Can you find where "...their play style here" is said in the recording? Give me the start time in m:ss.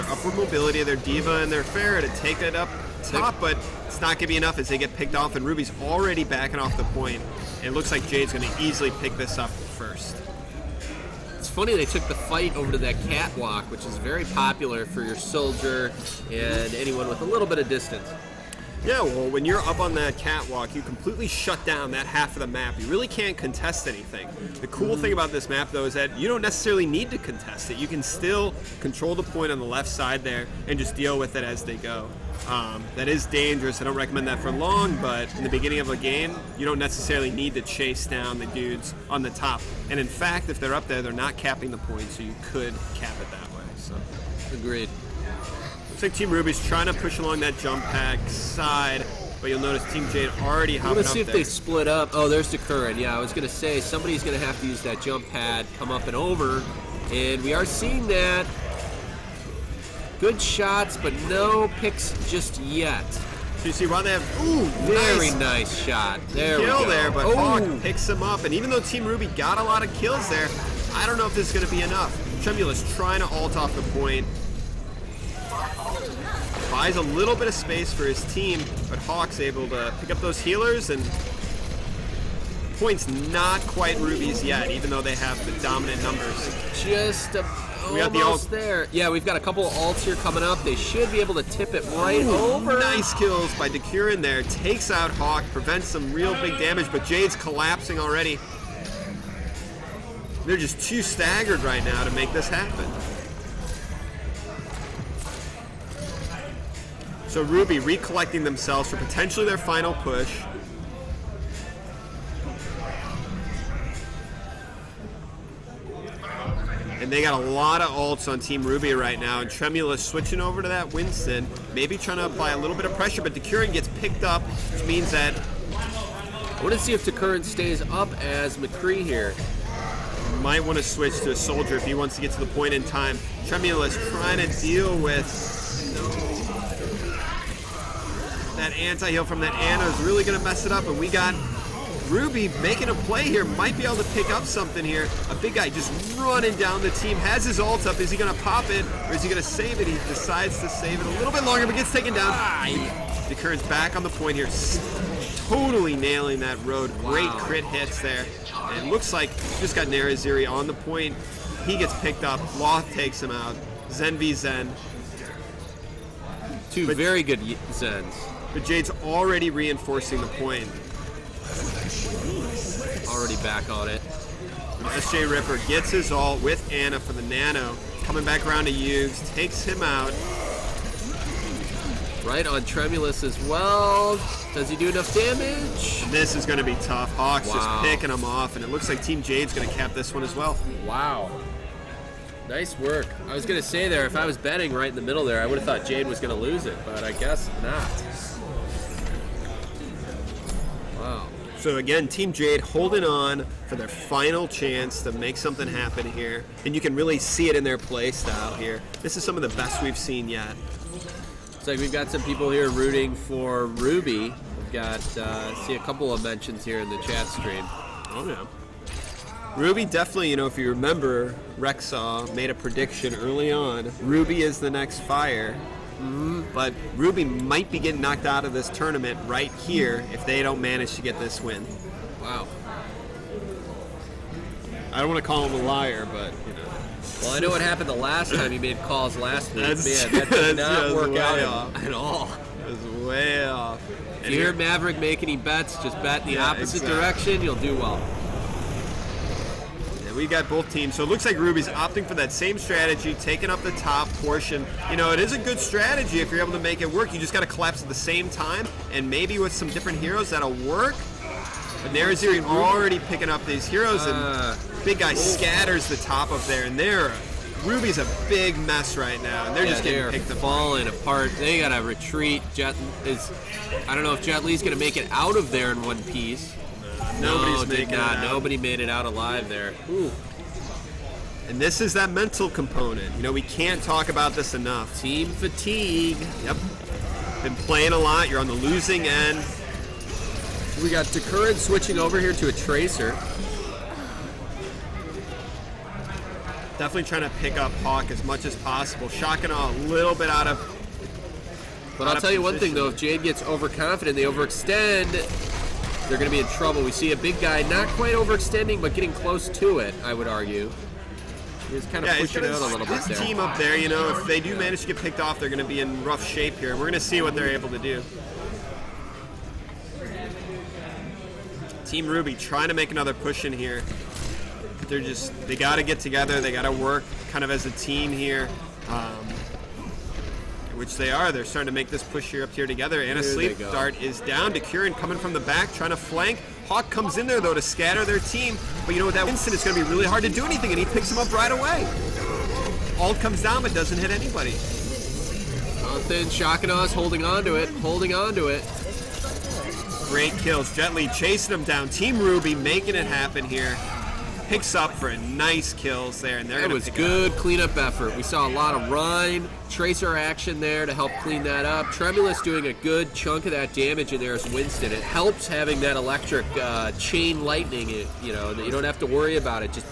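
3:27.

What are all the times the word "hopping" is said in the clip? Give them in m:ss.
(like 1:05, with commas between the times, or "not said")
0:50.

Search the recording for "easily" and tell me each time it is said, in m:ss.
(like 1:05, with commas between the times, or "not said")
0:08.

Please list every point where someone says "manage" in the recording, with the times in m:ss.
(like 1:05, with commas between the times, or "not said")
3:50, 5:14.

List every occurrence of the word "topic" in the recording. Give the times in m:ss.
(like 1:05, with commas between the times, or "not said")
not said.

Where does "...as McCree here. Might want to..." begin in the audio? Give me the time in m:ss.
2:08.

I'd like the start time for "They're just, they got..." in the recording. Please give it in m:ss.
5:24.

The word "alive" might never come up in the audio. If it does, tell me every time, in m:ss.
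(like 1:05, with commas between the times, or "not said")
4:39.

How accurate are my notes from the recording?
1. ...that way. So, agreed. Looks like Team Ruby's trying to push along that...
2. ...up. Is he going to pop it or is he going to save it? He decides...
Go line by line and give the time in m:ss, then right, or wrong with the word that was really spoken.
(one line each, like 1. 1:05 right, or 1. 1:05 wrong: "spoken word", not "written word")
1. 0:43 right
2. 2:27 right.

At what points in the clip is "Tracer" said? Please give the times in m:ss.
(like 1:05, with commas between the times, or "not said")
4:52, 5:59.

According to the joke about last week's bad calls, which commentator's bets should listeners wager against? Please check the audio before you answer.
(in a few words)
Maverick.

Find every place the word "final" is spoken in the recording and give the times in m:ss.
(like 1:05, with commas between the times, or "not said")
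1:49, 3:23.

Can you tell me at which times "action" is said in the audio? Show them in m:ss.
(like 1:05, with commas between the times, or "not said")
6:00.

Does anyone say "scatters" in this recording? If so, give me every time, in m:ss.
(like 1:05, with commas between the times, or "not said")
4:25, 5:37.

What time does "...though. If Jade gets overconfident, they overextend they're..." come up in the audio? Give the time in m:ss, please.
5:02.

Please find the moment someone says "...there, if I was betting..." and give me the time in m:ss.
3:13.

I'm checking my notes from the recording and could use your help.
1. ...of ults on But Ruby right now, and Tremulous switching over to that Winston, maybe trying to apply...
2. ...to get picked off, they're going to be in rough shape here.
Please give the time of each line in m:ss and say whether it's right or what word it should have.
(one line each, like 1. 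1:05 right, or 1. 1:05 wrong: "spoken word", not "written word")
1. 1:57 wrong: "Team", not "But"
2. 5:14 right.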